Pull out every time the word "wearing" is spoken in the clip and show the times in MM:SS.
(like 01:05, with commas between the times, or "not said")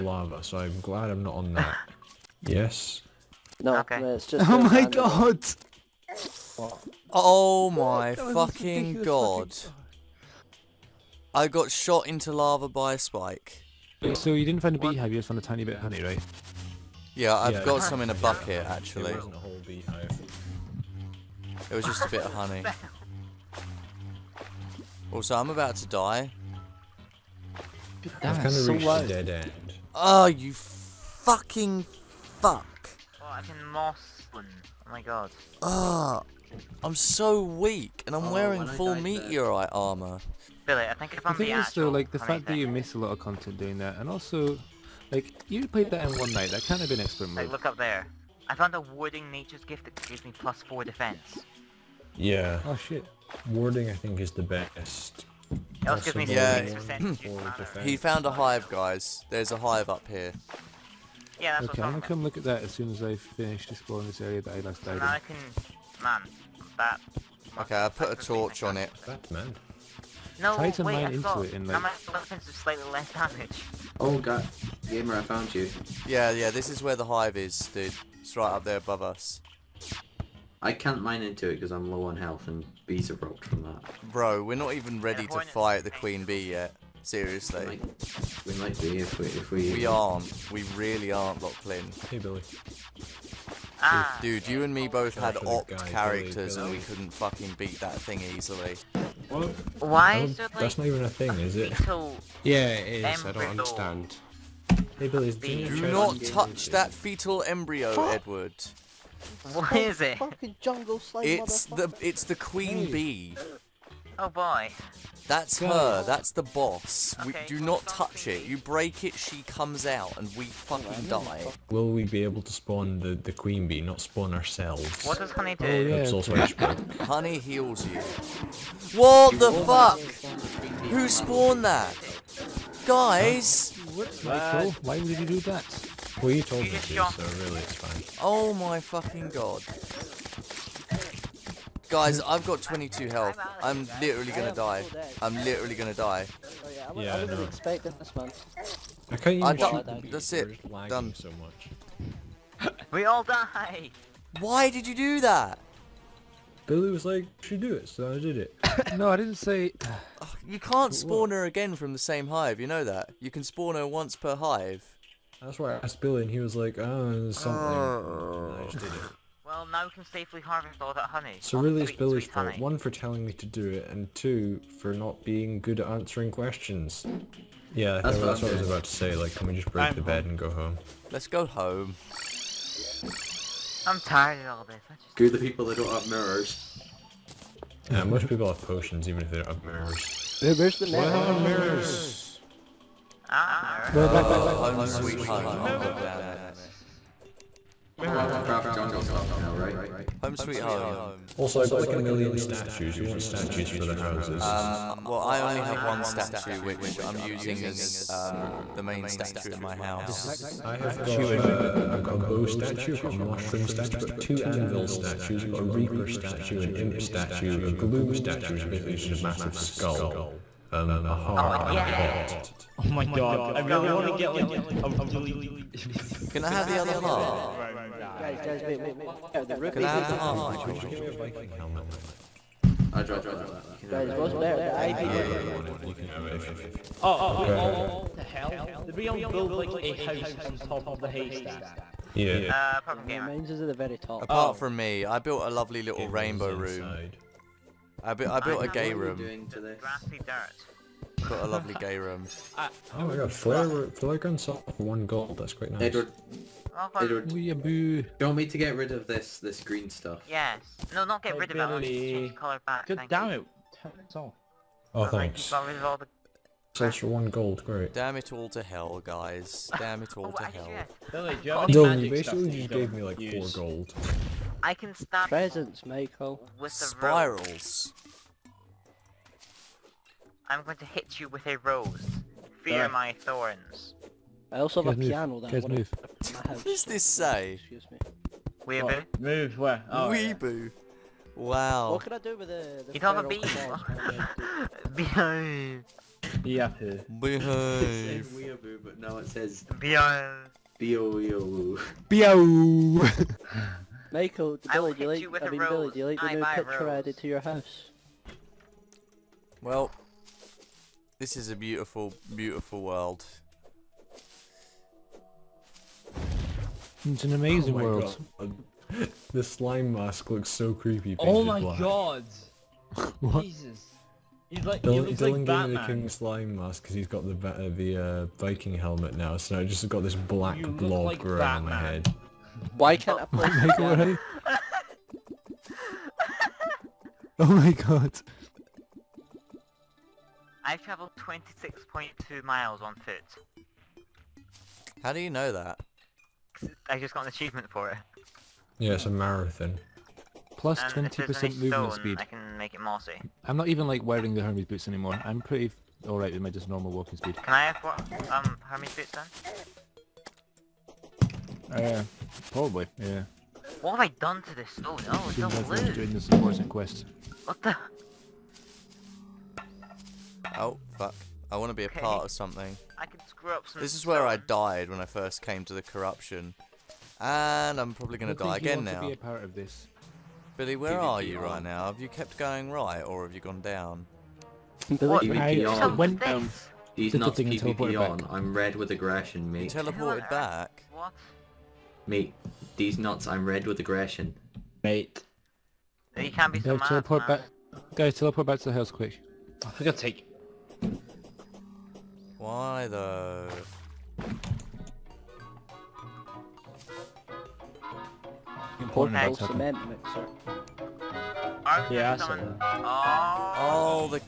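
00:38, 05:54.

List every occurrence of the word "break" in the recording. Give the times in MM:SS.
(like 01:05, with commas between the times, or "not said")
01:58, 02:59.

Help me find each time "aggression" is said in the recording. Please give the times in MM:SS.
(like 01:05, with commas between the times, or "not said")
06:28, 06:33.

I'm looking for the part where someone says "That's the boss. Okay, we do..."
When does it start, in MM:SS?
01:56.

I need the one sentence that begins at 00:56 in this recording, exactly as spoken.
percent He found a hive, guys.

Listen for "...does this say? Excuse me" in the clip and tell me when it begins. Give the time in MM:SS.
04:46.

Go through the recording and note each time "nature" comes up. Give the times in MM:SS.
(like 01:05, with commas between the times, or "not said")
00:49.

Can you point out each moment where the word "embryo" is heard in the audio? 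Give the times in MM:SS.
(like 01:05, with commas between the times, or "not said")
01:43, 01:47.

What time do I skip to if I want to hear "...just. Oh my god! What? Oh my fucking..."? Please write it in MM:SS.
00:04.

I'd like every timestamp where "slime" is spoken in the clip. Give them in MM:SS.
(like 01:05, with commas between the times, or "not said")
05:19, 05:26.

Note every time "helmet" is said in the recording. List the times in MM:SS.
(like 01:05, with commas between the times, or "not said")
03:51, 05:28.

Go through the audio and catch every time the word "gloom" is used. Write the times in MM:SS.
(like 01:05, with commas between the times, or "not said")
03:37.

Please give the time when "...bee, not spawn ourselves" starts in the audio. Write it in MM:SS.
02:03.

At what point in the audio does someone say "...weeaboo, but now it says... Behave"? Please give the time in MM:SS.
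04:58.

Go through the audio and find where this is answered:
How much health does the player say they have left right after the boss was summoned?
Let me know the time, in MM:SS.
02:22.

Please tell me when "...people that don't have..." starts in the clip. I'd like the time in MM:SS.
03:05.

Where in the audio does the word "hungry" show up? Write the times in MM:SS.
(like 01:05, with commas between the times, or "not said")
not said.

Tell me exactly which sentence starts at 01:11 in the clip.
my weapons do slightly less damage.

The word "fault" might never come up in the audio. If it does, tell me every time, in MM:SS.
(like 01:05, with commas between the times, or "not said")
02:52.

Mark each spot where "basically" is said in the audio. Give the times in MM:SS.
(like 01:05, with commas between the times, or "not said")
03:38, 04:32.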